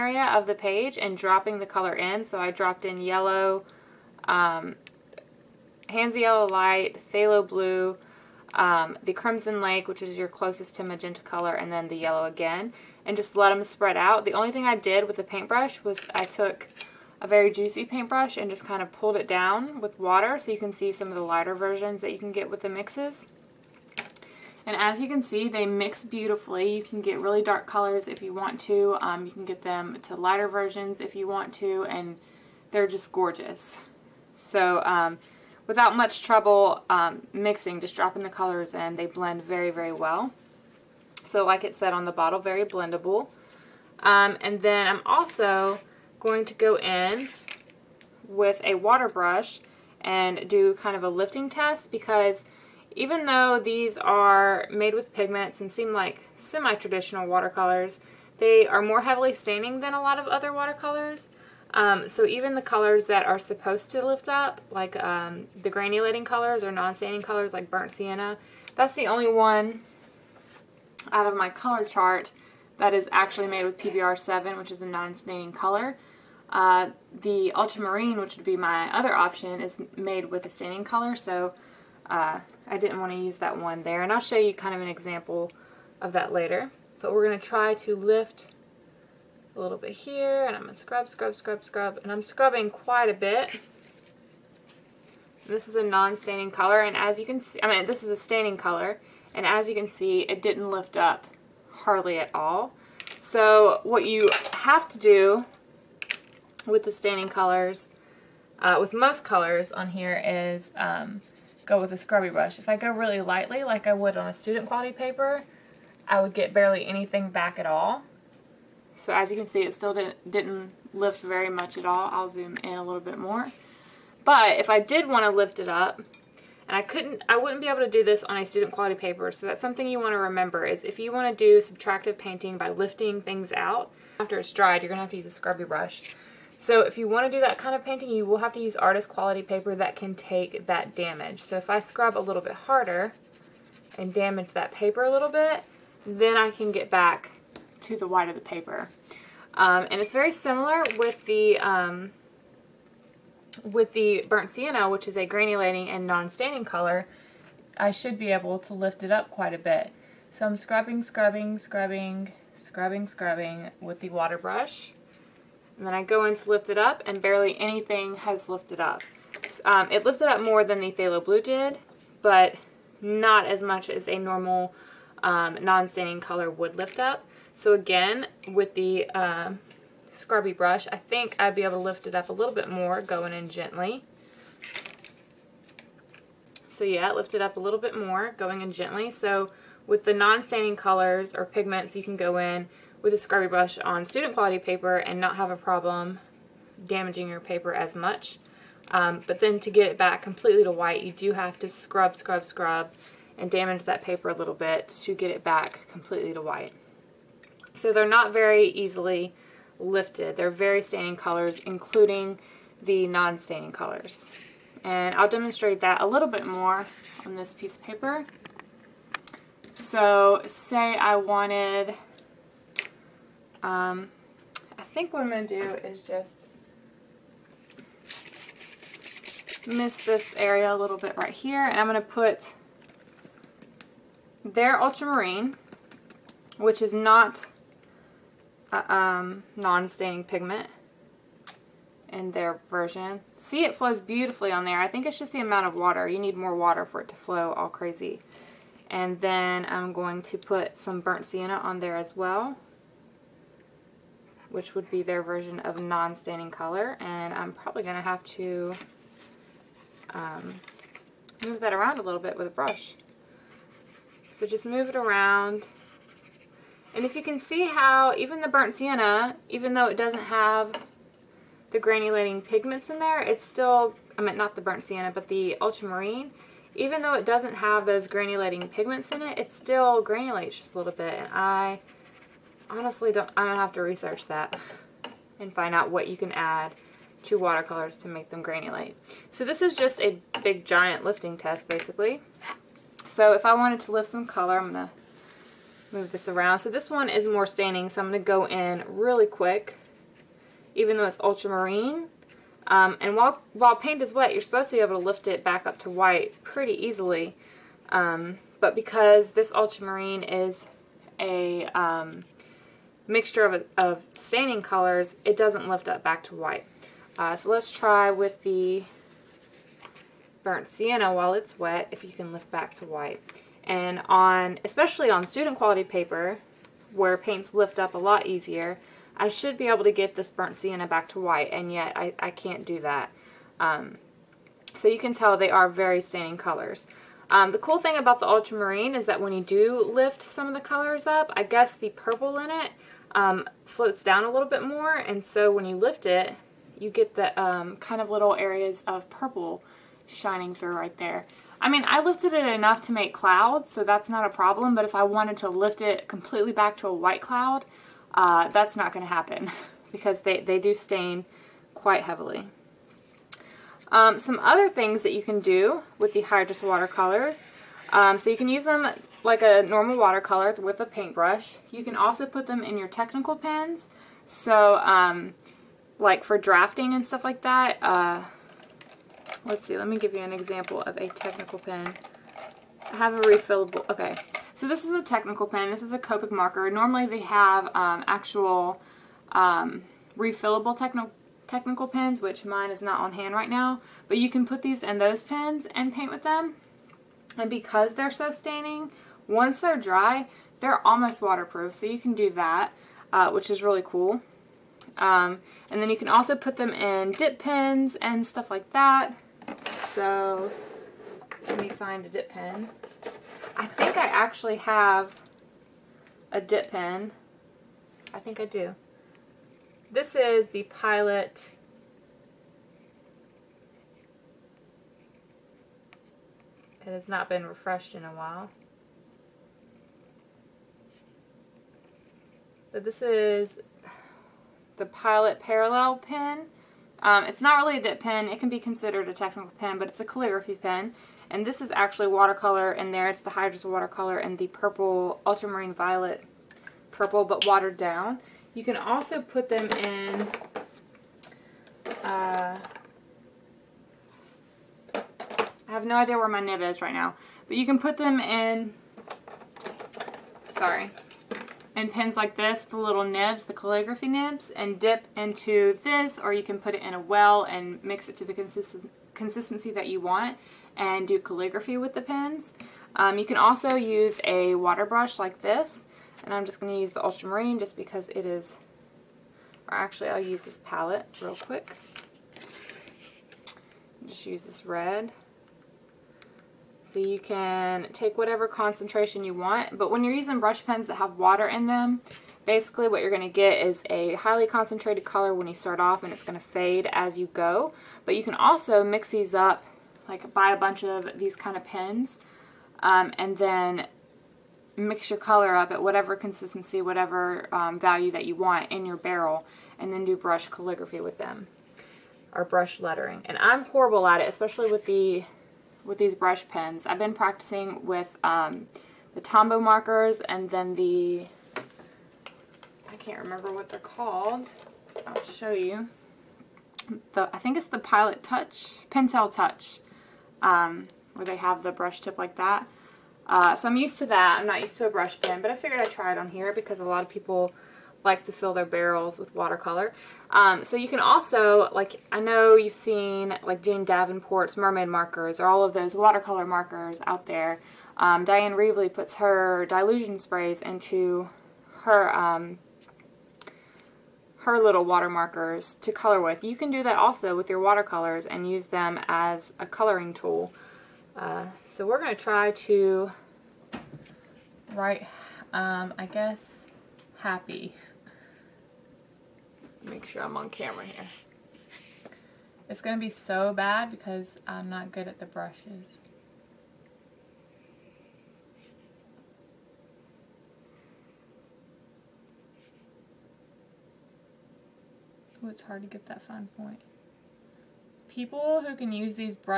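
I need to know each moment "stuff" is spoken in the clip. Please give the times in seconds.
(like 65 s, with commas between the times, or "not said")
377 s, 408 s.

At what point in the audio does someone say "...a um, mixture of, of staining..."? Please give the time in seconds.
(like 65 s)
311 s.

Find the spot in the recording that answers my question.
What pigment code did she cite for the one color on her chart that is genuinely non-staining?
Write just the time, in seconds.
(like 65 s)
73 s.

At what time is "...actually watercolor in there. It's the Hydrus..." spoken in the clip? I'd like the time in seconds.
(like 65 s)
441 s.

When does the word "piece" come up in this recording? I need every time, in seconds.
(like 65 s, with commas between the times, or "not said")
217 s.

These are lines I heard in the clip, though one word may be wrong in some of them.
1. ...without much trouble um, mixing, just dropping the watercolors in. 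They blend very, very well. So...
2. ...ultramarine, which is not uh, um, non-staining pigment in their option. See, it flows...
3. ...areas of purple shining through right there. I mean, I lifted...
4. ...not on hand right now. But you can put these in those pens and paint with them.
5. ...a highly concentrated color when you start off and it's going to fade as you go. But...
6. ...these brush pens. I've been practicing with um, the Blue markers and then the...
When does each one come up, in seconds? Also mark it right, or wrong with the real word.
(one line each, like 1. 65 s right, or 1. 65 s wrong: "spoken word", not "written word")
1. 35 s wrong: "colors", not "watercolors"
2. 234 s wrong: "version", not "option"
3. 348 s right
4. 392 s right
5. 493 s right
6. 515 s wrong: "Tombow", not "Blue".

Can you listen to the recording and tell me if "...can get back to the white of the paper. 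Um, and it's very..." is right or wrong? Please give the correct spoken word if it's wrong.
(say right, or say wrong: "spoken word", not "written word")
right.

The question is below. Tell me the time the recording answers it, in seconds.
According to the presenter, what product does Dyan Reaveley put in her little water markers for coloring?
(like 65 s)
549 s.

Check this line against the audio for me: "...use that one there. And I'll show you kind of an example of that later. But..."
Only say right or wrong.
right.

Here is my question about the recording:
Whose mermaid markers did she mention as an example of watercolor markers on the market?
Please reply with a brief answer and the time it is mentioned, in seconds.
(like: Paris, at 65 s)
Jane Davenport, at 543 s.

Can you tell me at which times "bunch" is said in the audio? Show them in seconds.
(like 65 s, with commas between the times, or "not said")
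500 s.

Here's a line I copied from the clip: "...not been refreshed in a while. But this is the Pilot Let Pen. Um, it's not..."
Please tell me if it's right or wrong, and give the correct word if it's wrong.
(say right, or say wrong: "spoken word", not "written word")
wrong: "Parallel", not "Let".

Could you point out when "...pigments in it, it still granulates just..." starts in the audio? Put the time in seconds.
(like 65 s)
278 s.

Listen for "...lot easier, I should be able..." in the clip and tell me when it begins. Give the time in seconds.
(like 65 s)
327 s.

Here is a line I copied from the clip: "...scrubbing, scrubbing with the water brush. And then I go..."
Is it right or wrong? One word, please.
right.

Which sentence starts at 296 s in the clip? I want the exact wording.
So this one is more staining, so I'm going to go in really quick, even though it's ultramarine.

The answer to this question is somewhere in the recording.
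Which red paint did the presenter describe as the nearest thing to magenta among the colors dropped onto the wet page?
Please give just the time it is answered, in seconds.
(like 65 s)
9 s.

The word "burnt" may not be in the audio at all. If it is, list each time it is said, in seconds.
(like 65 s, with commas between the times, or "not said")
67 s, 154 s, 251 s, 268 s, 274 s, 320 s, 330 s.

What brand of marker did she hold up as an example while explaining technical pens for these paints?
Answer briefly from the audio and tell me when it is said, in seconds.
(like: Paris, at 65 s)
Copic, at 385 s.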